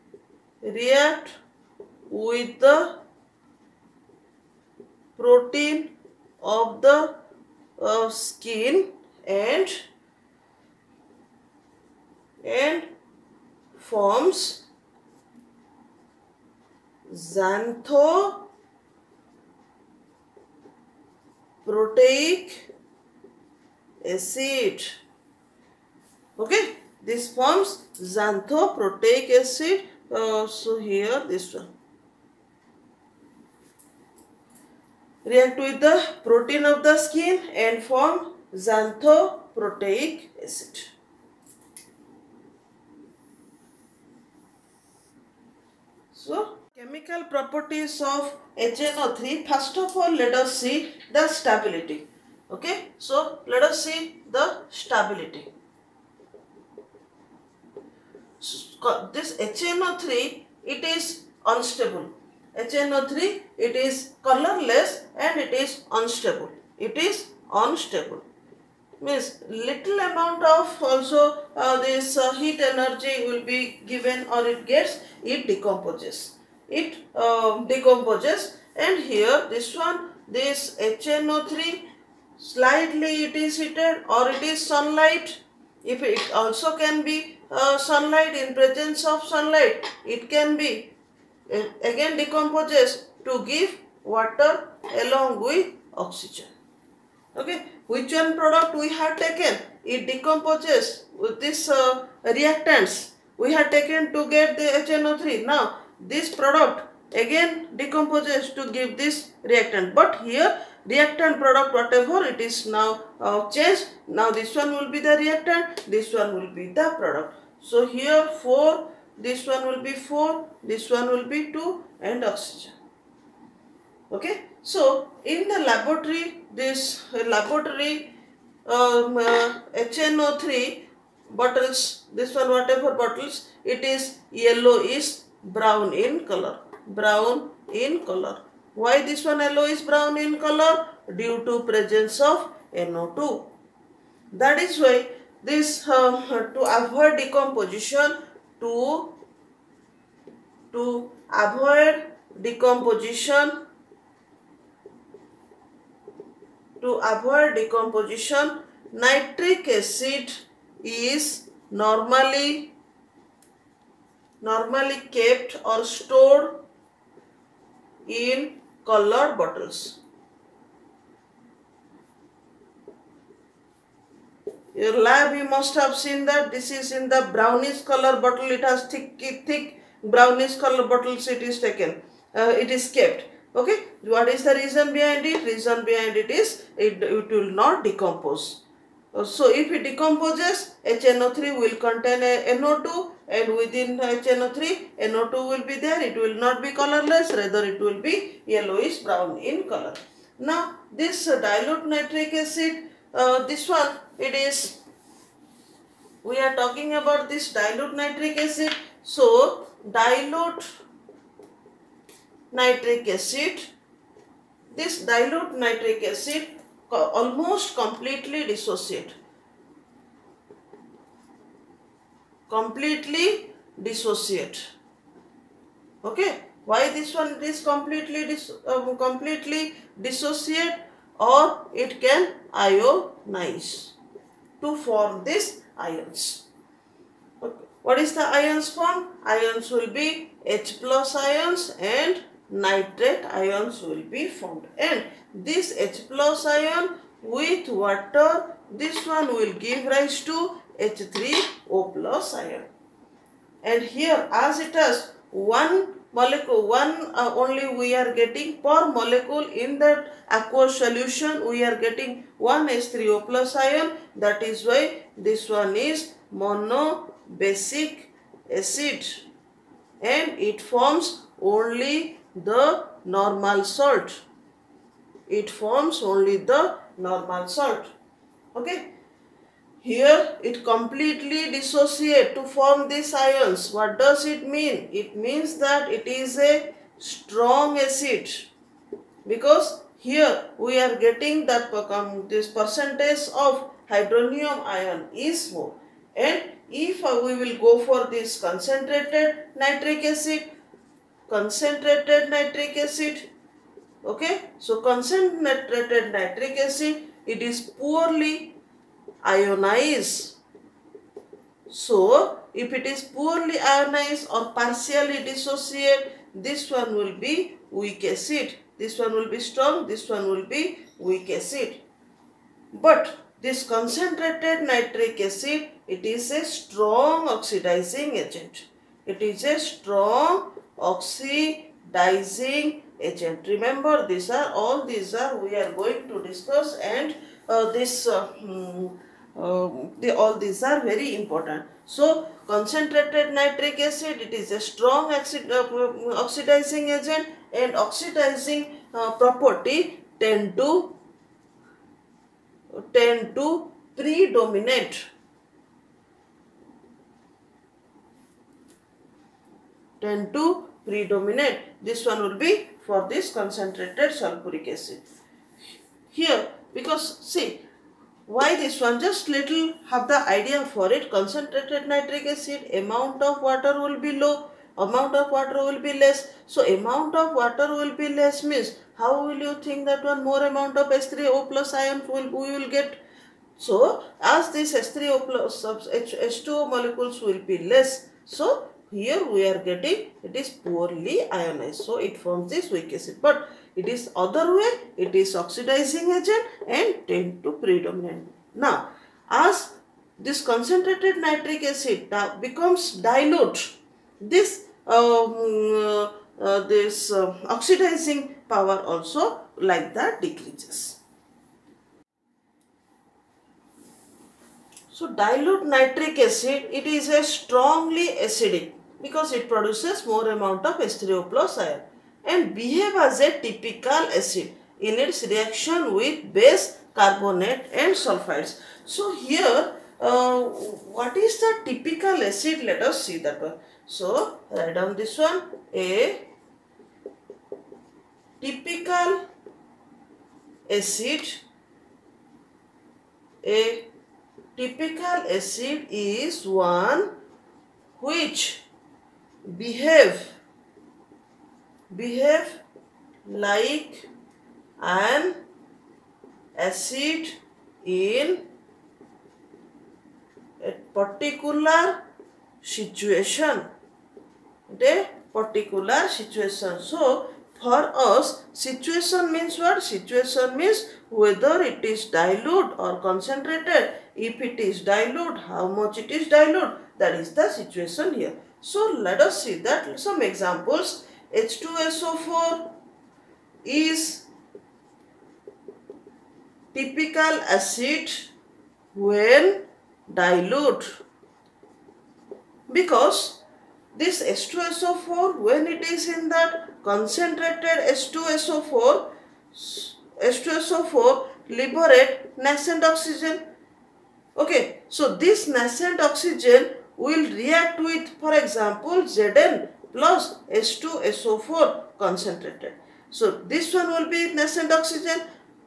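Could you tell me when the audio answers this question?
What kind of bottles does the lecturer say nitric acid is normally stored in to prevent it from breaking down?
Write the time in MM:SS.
02:48.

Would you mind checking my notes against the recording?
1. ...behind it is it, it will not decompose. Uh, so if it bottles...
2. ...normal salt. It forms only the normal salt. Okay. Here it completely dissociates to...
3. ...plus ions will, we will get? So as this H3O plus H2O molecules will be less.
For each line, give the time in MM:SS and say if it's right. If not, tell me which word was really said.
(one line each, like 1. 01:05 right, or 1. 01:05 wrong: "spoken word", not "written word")
1. 03:05 wrong: "decomposes", not "bottles"
2. 04:33 right
3. 06:21 right.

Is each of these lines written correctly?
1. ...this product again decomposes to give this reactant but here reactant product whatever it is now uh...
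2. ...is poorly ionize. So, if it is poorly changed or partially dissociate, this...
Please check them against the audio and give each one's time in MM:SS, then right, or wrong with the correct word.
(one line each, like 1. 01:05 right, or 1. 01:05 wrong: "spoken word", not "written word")
1. 01:46 right
2. 05:07 wrong: "ionized", not "changed".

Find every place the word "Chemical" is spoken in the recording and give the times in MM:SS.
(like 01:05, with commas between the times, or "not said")
00:46.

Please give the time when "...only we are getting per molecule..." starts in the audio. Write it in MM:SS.
04:17.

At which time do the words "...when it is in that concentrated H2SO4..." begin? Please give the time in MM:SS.
08:15.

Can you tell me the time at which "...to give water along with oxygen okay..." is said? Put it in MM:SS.
01:33.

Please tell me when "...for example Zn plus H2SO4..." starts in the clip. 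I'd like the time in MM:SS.
08:28.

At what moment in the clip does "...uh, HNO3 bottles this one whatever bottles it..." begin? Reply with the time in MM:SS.
02:09.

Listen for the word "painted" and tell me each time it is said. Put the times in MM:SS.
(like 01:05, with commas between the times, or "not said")
not said.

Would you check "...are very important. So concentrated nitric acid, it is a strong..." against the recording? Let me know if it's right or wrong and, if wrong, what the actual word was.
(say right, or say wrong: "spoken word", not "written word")
right.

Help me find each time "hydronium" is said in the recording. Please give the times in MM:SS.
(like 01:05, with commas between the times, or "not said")
04:53.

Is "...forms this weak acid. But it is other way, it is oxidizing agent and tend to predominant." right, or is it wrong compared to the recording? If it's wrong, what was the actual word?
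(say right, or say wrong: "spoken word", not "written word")
right.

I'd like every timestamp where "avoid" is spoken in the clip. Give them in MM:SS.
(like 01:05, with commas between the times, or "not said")
02:26, 02:31, 02:37.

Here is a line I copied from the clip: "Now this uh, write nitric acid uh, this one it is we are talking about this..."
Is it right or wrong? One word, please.
wrong.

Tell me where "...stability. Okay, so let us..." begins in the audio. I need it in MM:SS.
00:51.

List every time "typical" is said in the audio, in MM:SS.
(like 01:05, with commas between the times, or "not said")
07:03, 07:11, 07:18, 07:24, 08:06.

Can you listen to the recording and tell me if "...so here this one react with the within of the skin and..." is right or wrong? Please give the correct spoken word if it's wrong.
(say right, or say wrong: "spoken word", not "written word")
wrong: "protein", not "within".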